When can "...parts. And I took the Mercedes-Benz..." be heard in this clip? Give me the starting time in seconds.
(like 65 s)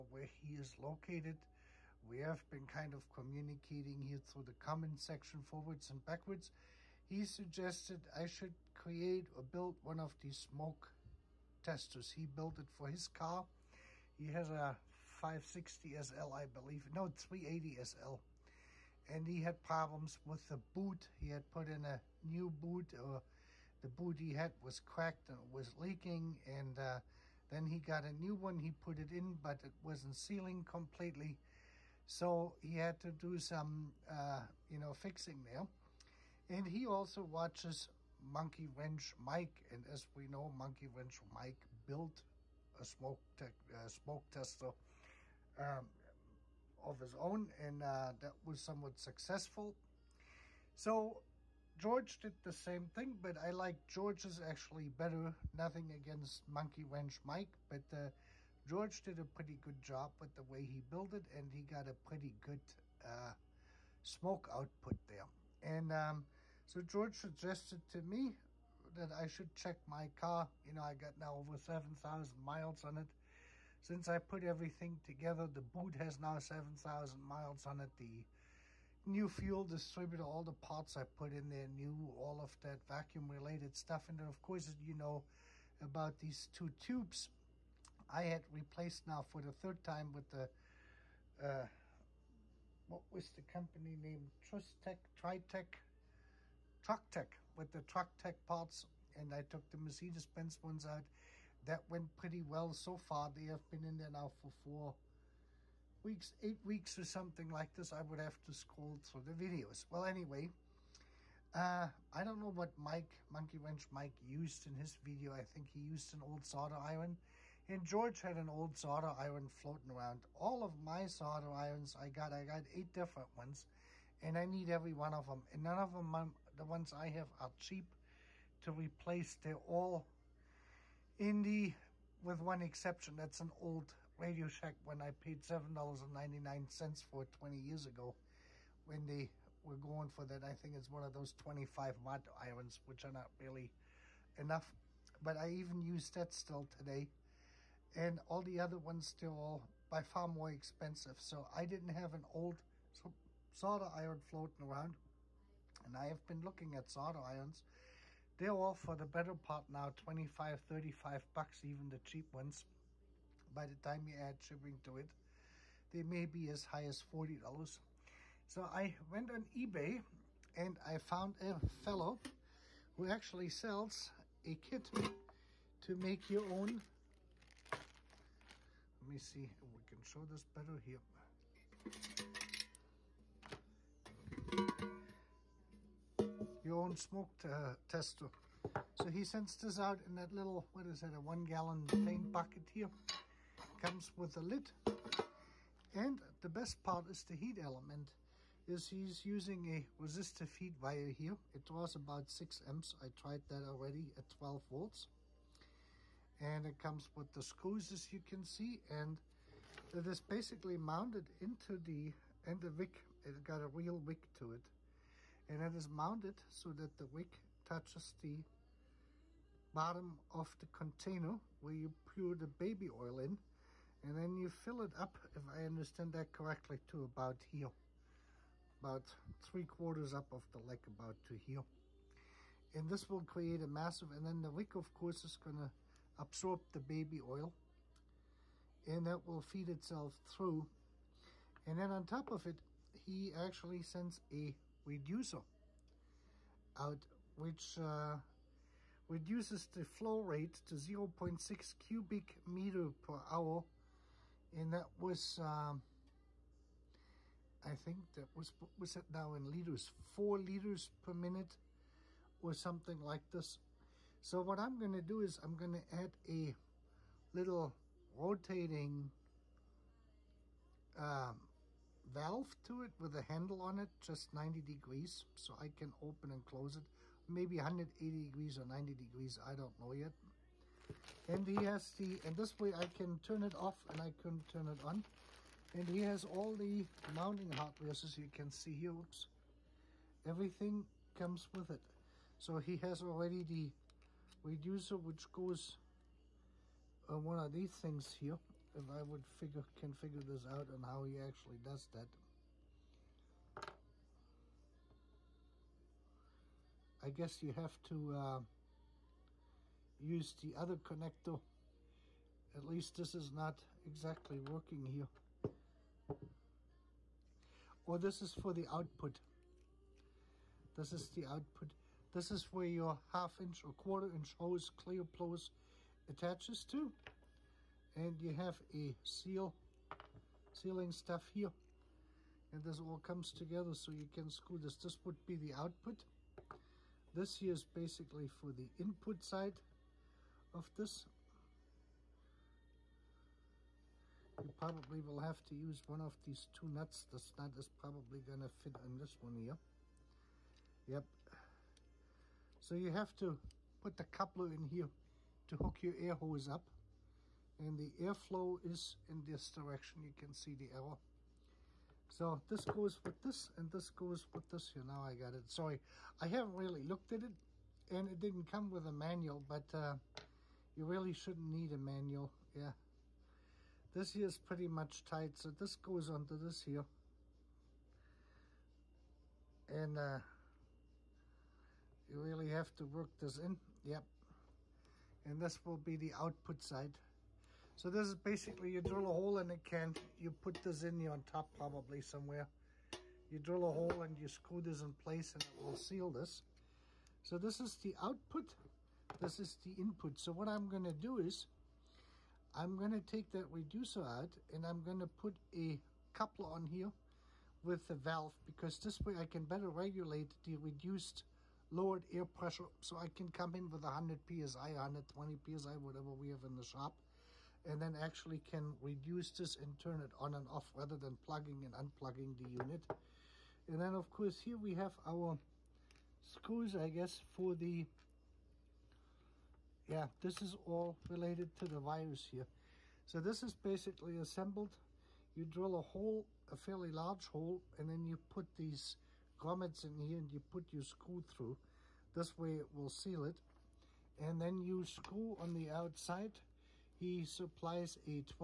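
98 s.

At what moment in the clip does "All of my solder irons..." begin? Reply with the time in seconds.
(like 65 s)
120 s.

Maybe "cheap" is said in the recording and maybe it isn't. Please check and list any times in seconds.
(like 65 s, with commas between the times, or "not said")
127 s, 161 s.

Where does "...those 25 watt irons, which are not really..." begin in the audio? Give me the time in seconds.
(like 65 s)
141 s.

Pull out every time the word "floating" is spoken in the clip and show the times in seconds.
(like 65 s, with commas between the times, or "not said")
119 s, 154 s.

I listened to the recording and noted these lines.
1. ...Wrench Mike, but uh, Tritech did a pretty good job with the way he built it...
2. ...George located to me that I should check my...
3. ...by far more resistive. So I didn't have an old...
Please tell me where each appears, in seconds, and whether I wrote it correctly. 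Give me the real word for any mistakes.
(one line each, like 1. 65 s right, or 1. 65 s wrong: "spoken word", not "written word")
1. 56 s wrong: "George", not "Tritech"
2. 66 s wrong: "suggested", not "located"
3. 149 s wrong: "expensive", not "resistive".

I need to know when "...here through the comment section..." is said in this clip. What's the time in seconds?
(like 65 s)
4 s.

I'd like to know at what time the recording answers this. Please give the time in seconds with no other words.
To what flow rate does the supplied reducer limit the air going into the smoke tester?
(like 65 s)
250 s.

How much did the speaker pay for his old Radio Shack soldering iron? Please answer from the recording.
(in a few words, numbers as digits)
$7.99.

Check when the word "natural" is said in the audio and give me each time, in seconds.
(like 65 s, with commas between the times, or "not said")
not said.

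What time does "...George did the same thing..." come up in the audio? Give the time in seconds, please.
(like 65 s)
51 s.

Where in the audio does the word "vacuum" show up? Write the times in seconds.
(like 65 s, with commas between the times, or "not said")
82 s.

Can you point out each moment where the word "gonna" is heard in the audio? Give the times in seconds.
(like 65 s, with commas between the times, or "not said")
235 s, 400 s.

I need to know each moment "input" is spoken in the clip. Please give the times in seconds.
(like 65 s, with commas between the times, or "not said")
338 s, 399 s.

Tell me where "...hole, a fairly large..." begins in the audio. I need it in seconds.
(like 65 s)
435 s.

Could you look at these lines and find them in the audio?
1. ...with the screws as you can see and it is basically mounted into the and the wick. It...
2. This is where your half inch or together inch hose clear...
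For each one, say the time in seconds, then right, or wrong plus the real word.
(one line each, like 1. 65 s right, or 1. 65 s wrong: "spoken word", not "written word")
1. 207 s right
2. 322 s wrong: "quarter", not "together".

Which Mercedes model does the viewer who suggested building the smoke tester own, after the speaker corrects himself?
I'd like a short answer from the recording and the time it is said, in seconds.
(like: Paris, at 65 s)
380 SL, at 17 s.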